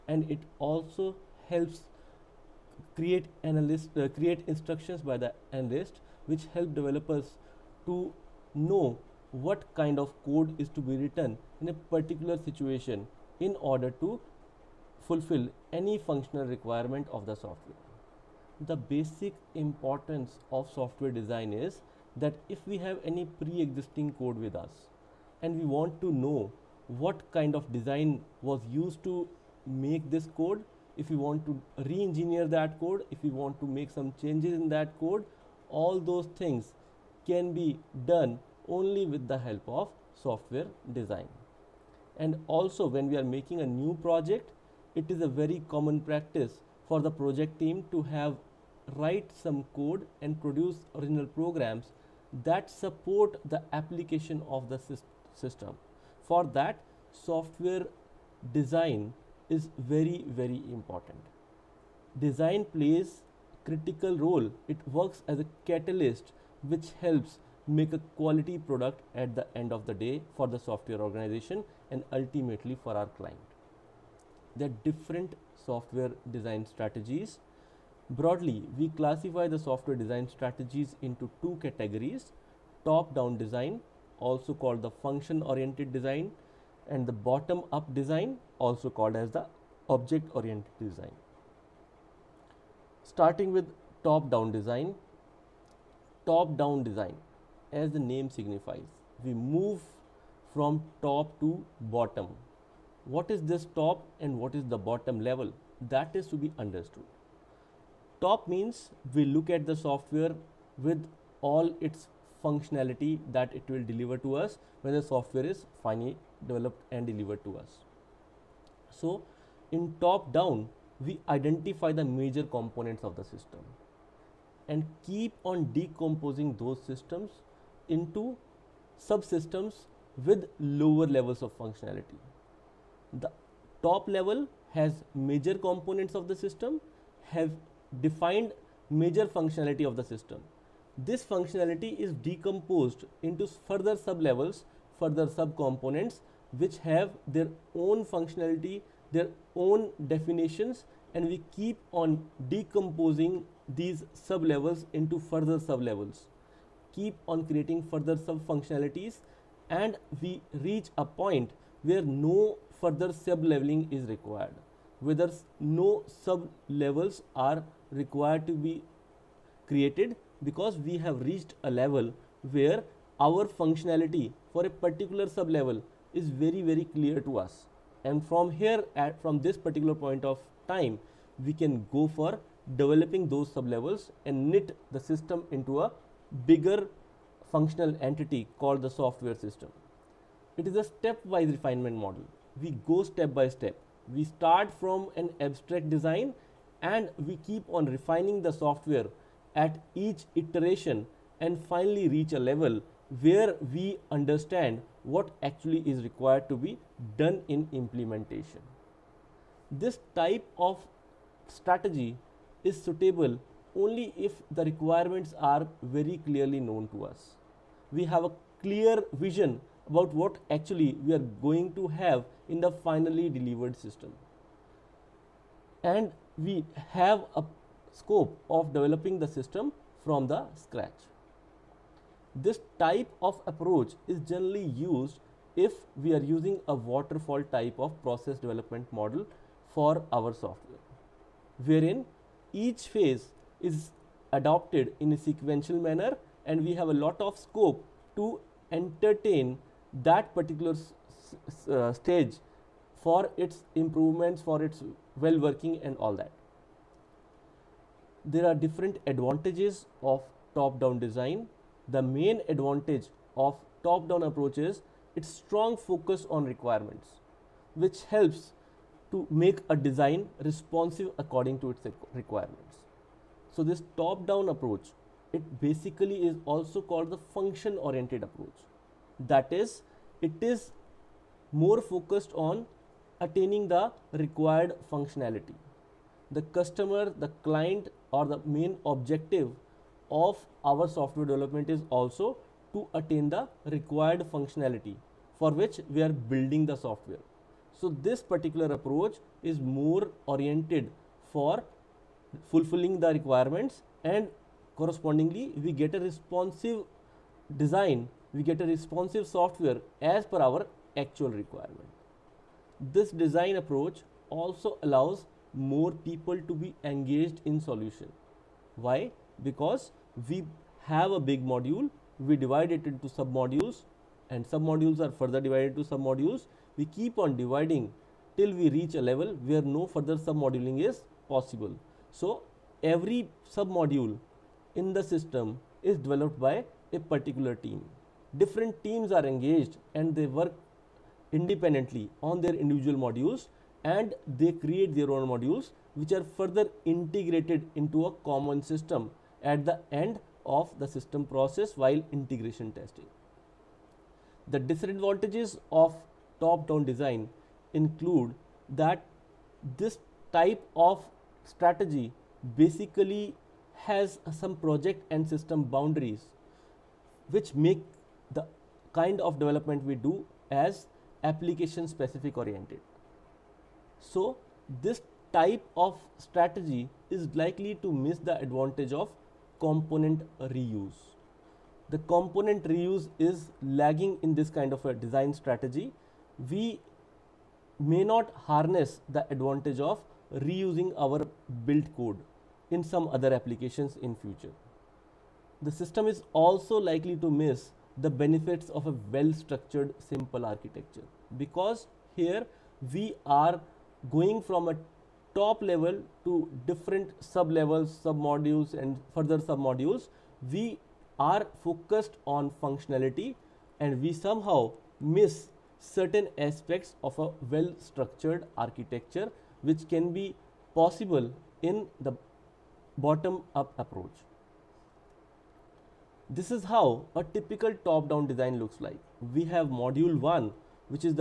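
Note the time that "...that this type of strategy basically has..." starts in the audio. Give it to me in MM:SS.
05:58.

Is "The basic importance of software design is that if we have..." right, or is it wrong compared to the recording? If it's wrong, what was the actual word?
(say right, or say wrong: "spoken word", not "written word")
right.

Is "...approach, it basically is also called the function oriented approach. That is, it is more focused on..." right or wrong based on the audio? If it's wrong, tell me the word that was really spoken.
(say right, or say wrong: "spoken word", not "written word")
right.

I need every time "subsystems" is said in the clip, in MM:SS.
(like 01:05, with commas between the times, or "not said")
02:08.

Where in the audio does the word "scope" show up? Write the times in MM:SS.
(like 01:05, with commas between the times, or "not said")
03:47, 04:07.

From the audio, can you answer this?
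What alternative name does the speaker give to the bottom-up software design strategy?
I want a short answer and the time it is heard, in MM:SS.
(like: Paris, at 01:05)
object-oriented design, at 01:29.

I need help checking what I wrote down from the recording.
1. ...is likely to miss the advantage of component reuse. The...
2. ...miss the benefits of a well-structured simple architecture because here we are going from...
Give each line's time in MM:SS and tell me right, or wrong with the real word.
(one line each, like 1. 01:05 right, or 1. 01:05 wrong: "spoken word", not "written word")
1. 06:17 right
2. 06:37 right.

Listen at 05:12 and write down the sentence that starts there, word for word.
This design approach also allows more people to be engaged in solution.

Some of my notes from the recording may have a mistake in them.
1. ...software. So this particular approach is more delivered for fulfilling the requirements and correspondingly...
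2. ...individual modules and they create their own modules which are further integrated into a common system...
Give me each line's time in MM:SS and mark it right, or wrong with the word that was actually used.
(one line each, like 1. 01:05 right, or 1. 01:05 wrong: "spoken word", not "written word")
1. 04:56 wrong: "oriented", not "delivered"
2. 05:42 right.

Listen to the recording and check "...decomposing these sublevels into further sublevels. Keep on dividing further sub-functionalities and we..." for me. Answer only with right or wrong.
wrong.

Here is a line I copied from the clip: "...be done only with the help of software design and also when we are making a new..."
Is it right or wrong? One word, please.
right.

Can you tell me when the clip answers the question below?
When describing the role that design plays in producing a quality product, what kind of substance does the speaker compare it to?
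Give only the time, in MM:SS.
01:05.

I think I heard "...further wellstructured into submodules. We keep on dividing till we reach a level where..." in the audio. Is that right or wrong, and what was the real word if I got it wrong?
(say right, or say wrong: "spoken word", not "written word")
wrong: "divided", not "wellstructured".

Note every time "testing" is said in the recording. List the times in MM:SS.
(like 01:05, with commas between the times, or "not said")
05:52.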